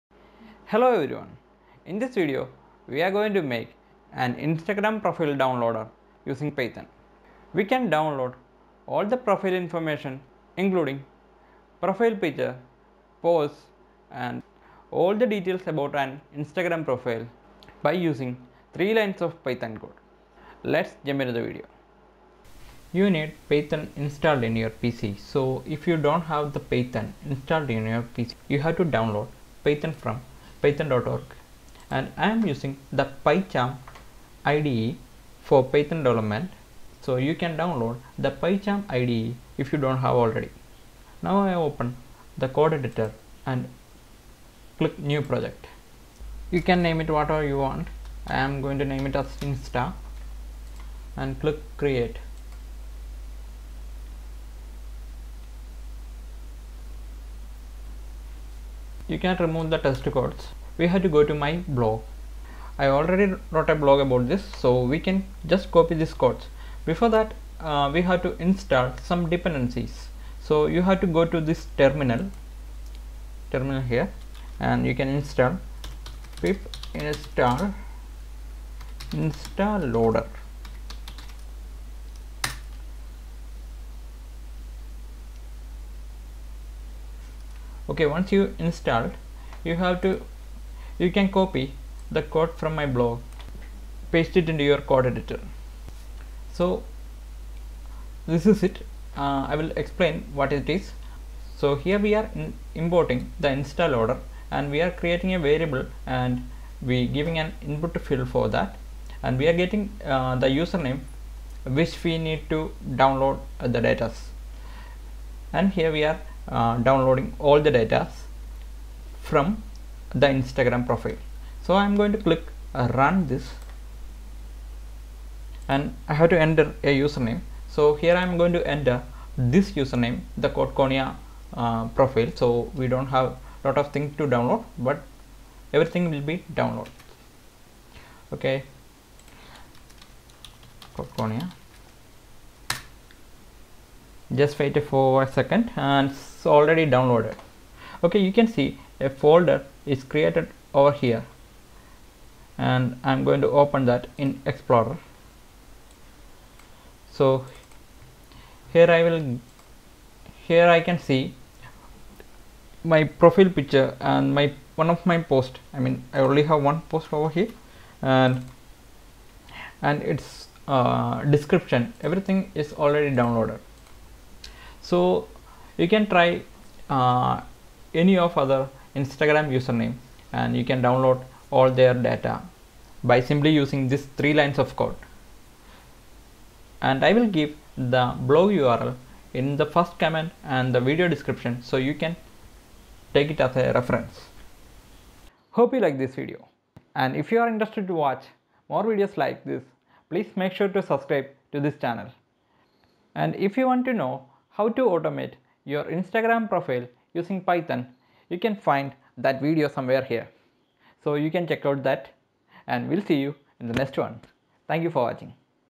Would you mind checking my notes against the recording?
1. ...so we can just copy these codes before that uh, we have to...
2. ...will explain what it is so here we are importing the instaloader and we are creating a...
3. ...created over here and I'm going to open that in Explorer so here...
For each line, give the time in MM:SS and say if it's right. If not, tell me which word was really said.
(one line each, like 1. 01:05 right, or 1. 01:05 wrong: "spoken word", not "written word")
1. 01:04 right
2. 01:39 right
3. 02:30 right.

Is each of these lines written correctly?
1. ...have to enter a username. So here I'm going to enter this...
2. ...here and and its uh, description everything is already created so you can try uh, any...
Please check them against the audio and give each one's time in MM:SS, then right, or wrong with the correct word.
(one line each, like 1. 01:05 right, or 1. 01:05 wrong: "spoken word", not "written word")
1. 02:06 right
2. 02:47 wrong: "downloaded", not "created".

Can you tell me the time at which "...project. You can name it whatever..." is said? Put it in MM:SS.
00:45.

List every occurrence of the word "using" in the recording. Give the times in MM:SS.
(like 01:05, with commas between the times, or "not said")
00:06, 00:17, 00:32, 03:03, 03:27.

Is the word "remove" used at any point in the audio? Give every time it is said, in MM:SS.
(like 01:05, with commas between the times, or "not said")
00:59.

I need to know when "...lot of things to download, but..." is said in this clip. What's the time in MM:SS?
02:13.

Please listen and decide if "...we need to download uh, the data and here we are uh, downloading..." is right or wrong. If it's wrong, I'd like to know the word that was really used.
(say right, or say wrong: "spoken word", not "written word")
right.